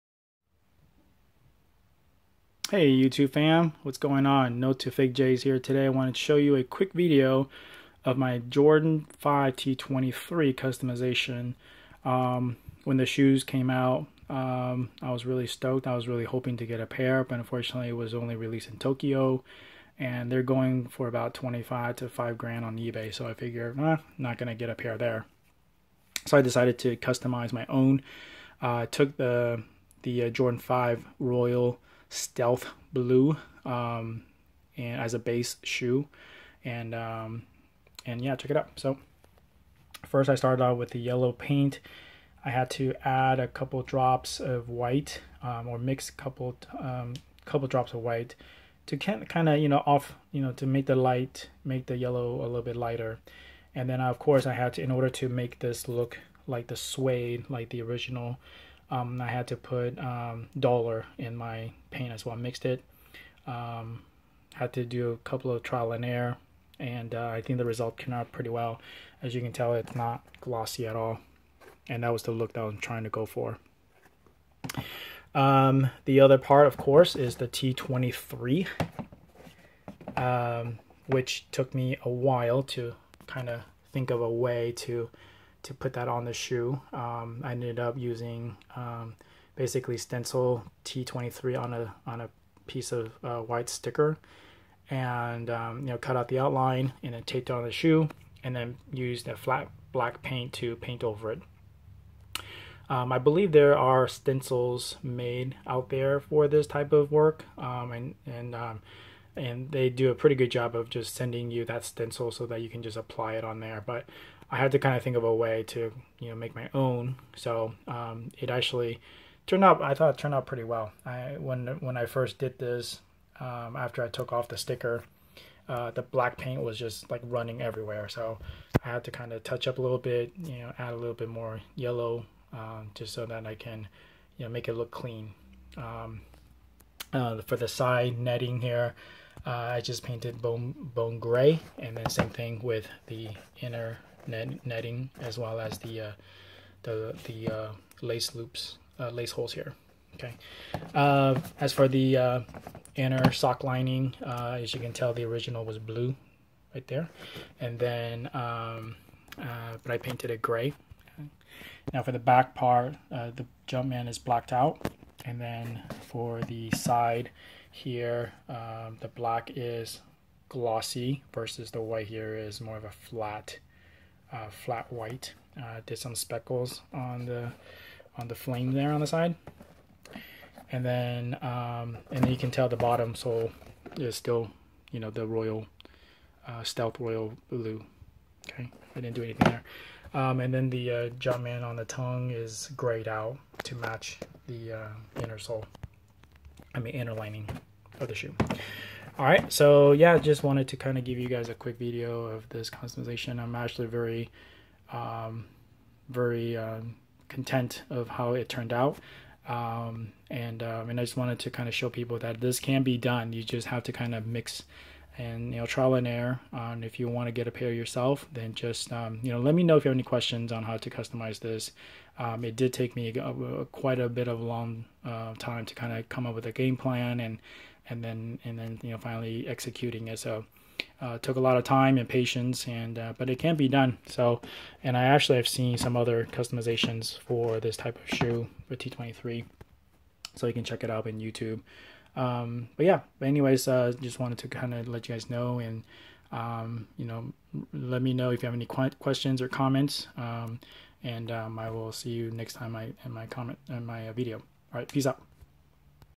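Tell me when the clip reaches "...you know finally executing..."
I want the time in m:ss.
3:48.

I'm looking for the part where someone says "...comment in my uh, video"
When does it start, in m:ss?
4:13.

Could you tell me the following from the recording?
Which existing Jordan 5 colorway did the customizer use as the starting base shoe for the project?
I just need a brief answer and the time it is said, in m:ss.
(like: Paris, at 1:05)
Royal stealth blue, at 0:31.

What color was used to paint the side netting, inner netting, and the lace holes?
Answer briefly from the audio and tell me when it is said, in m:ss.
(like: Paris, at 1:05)
Bone gray, at 2:20.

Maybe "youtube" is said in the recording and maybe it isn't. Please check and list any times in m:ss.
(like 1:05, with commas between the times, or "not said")
0:02, 4:01.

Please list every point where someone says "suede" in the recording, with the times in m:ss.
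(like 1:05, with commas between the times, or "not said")
0:56.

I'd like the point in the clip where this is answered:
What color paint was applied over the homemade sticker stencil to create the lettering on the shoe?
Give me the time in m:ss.
1:39.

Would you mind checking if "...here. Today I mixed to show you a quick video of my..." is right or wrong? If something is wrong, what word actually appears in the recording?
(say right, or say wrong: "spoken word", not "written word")
wrong: "wanted", not "mixed".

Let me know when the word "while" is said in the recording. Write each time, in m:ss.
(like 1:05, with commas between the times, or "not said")
1:22.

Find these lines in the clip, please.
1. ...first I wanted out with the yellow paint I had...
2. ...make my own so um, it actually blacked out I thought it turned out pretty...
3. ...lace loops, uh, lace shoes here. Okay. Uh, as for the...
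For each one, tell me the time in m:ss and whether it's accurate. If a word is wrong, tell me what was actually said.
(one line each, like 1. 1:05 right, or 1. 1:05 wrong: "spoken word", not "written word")
1. 0:40 wrong: "started", not "wanted"
2. 1:56 wrong: "turned", not "blacked"
3. 2:28 wrong: "holes", not "shoes".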